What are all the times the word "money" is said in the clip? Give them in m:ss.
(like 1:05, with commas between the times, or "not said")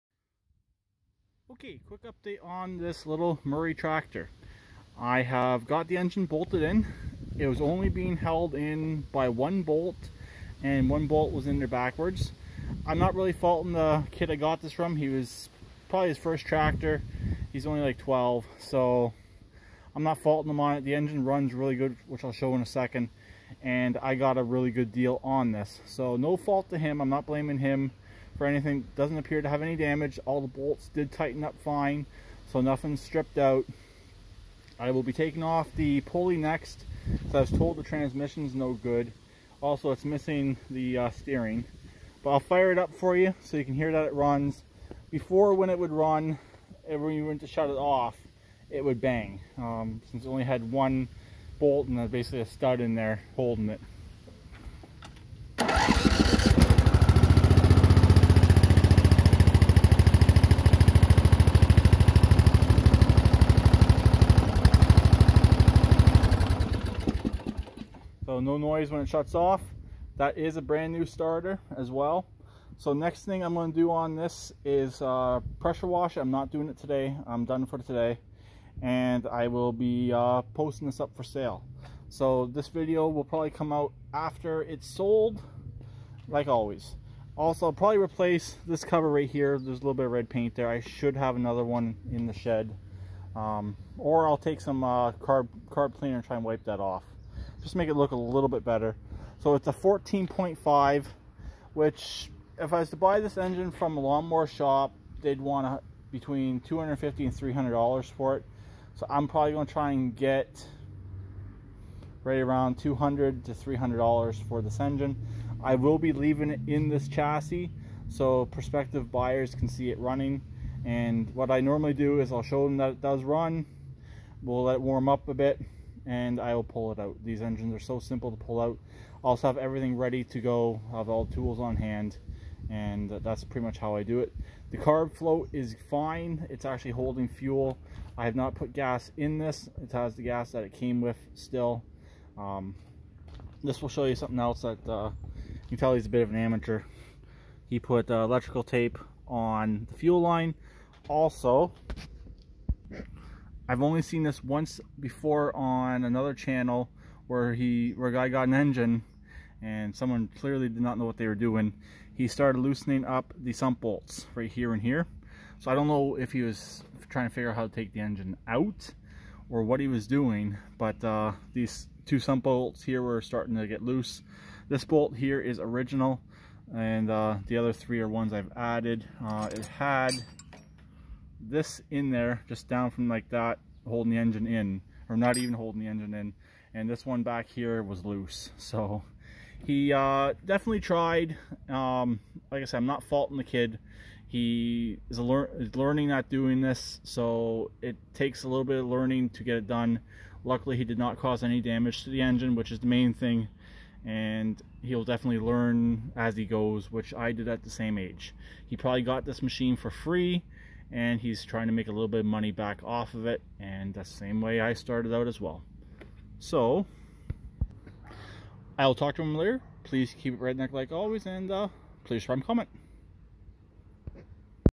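3:32.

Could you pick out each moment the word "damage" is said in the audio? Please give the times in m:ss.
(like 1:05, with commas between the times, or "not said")
0:29, 3:21.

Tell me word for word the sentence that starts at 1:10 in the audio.
That is a brand new starter as well.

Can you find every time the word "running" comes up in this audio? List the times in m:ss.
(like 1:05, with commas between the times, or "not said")
1:59.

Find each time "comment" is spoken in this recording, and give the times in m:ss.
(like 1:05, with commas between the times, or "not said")
3:42.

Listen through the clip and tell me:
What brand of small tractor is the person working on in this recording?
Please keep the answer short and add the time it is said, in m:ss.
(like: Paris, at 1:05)
Murray, at 0:03.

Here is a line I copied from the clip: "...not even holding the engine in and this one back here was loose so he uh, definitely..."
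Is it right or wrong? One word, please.
right.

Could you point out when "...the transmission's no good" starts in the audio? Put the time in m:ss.
0:37.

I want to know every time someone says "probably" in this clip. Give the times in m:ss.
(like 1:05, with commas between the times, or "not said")
0:15, 1:23, 1:27, 1:49, 3:28.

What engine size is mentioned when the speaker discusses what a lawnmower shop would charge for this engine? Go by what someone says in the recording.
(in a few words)
14.5.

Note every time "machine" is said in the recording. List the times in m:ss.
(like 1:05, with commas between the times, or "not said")
3:29.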